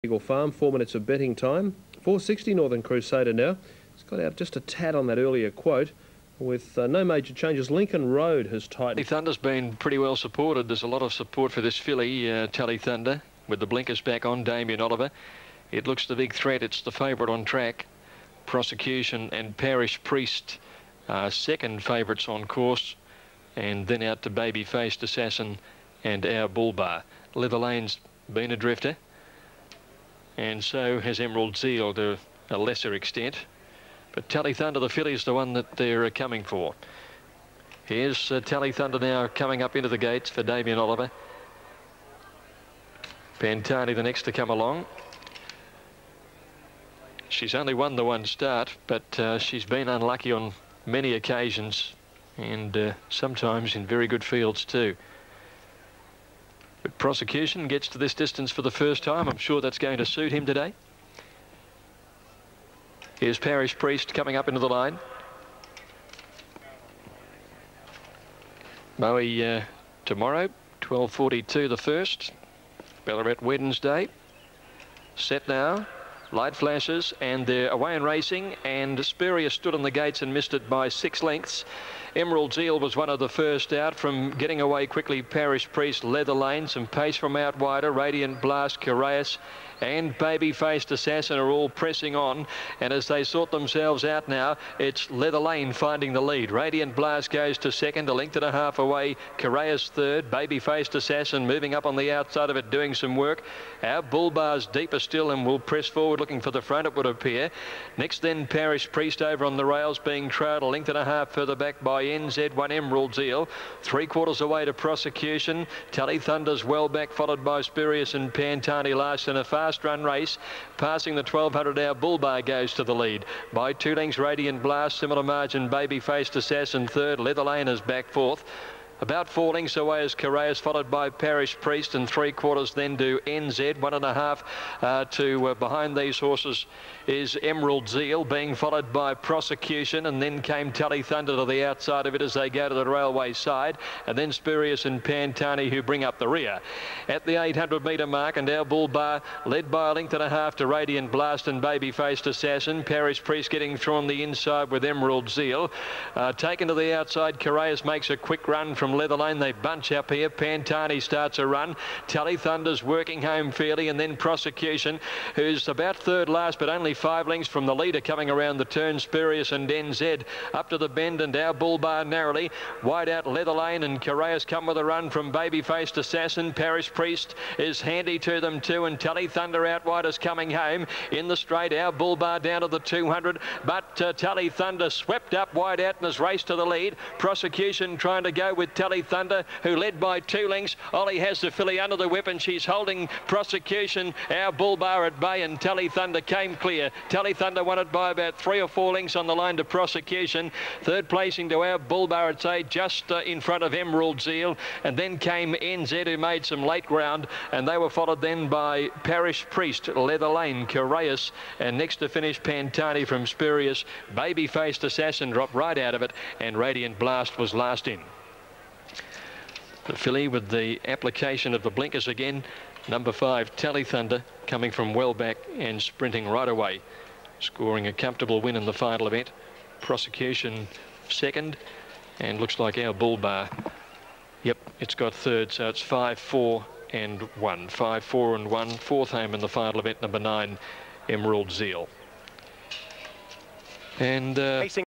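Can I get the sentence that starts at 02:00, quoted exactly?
Passing the 1200-our bull bar goes to the lead.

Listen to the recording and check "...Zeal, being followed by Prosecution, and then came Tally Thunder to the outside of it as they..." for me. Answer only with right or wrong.
right.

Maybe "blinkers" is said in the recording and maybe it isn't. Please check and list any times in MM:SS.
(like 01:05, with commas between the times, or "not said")
00:13, 03:41.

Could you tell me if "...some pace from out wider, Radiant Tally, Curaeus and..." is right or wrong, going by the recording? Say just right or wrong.
wrong.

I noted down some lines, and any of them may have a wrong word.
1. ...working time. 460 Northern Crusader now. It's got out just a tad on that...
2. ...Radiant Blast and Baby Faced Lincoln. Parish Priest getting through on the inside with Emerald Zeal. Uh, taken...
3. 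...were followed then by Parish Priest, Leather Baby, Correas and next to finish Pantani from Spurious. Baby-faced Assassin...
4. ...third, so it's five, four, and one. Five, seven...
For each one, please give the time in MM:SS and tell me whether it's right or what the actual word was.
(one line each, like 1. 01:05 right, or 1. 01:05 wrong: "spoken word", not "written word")
1. 00:01 wrong: "betting", not "working"
2. 02:30 wrong: "Assassin", not "Lincoln"
3. 03:27 wrong: "Lane", not "Baby"
4. 03:55 wrong: "four", not "seven".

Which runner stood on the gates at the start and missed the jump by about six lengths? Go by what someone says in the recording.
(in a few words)
Spurrier.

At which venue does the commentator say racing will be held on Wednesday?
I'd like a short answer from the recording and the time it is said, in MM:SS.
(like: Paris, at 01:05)
Ballarat, at 01:13.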